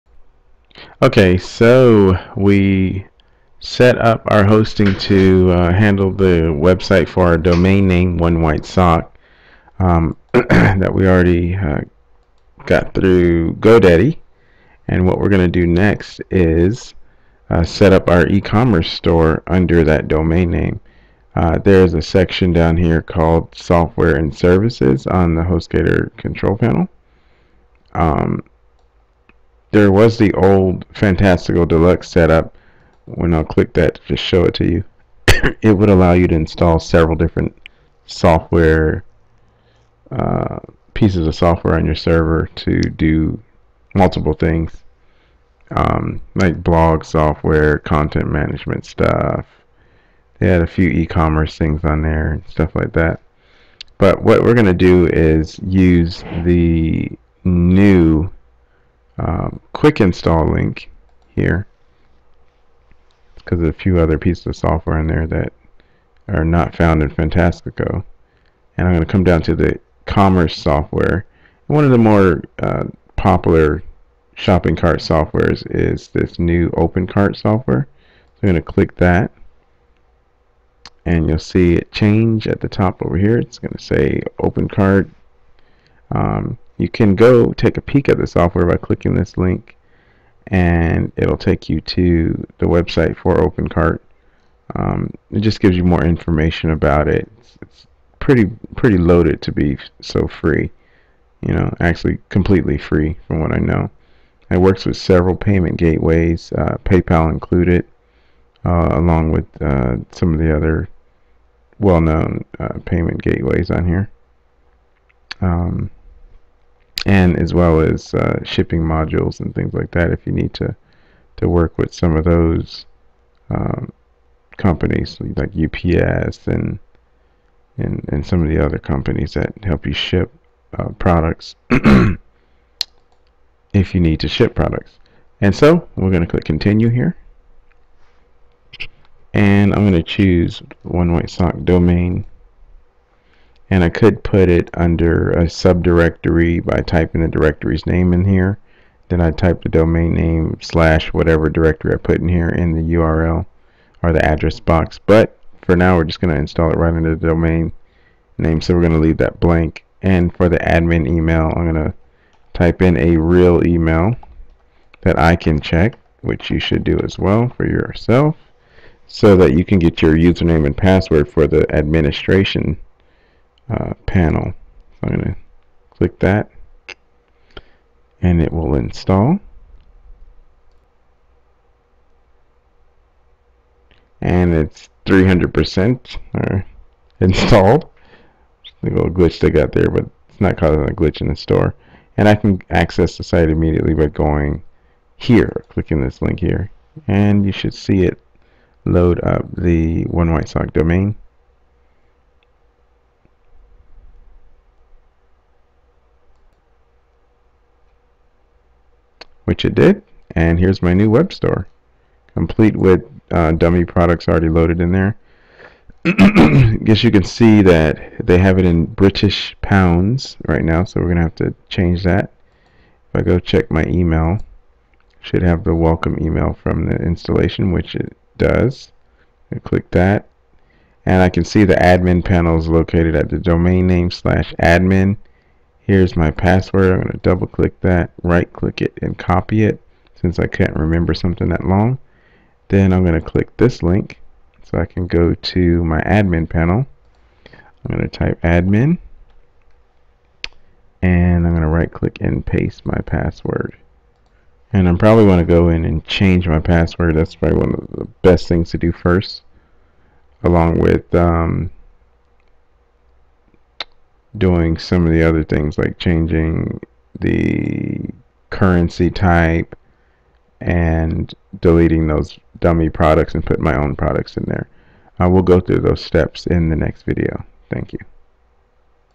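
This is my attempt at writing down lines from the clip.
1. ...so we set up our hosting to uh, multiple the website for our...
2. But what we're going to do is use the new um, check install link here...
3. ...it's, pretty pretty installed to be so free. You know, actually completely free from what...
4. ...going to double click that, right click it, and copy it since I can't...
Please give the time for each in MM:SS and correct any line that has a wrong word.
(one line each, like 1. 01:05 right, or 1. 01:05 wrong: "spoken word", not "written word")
1. 00:01 wrong: "handle", not "multiple"
2. 00:53 wrong: "quick", not "check"
3. 01:37 wrong: "loaded", not "installed"
4. 03:57 right.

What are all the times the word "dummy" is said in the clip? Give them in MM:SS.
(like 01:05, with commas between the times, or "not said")
03:33, 04:32.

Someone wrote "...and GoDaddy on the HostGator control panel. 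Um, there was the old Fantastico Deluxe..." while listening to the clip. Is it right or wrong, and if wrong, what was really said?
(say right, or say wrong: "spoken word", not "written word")
wrong: "Services", not "GoDaddy".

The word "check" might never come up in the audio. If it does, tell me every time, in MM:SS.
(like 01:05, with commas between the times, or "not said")
02:45, 03:43.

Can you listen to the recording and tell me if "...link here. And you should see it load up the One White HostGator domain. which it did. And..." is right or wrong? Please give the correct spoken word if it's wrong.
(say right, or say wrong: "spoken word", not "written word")
wrong: "Sock", not "HostGator".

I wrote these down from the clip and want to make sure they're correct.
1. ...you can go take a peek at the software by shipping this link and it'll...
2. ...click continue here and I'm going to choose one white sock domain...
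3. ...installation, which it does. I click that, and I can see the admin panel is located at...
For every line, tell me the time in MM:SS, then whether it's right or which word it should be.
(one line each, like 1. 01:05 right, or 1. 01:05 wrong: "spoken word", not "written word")
1. 01:26 wrong: "clicking", not "shipping"
2. 02:16 right
3. 03:46 right.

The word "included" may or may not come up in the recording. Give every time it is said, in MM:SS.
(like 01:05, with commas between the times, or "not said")
01:47.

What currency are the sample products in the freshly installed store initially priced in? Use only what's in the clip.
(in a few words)
British pounds.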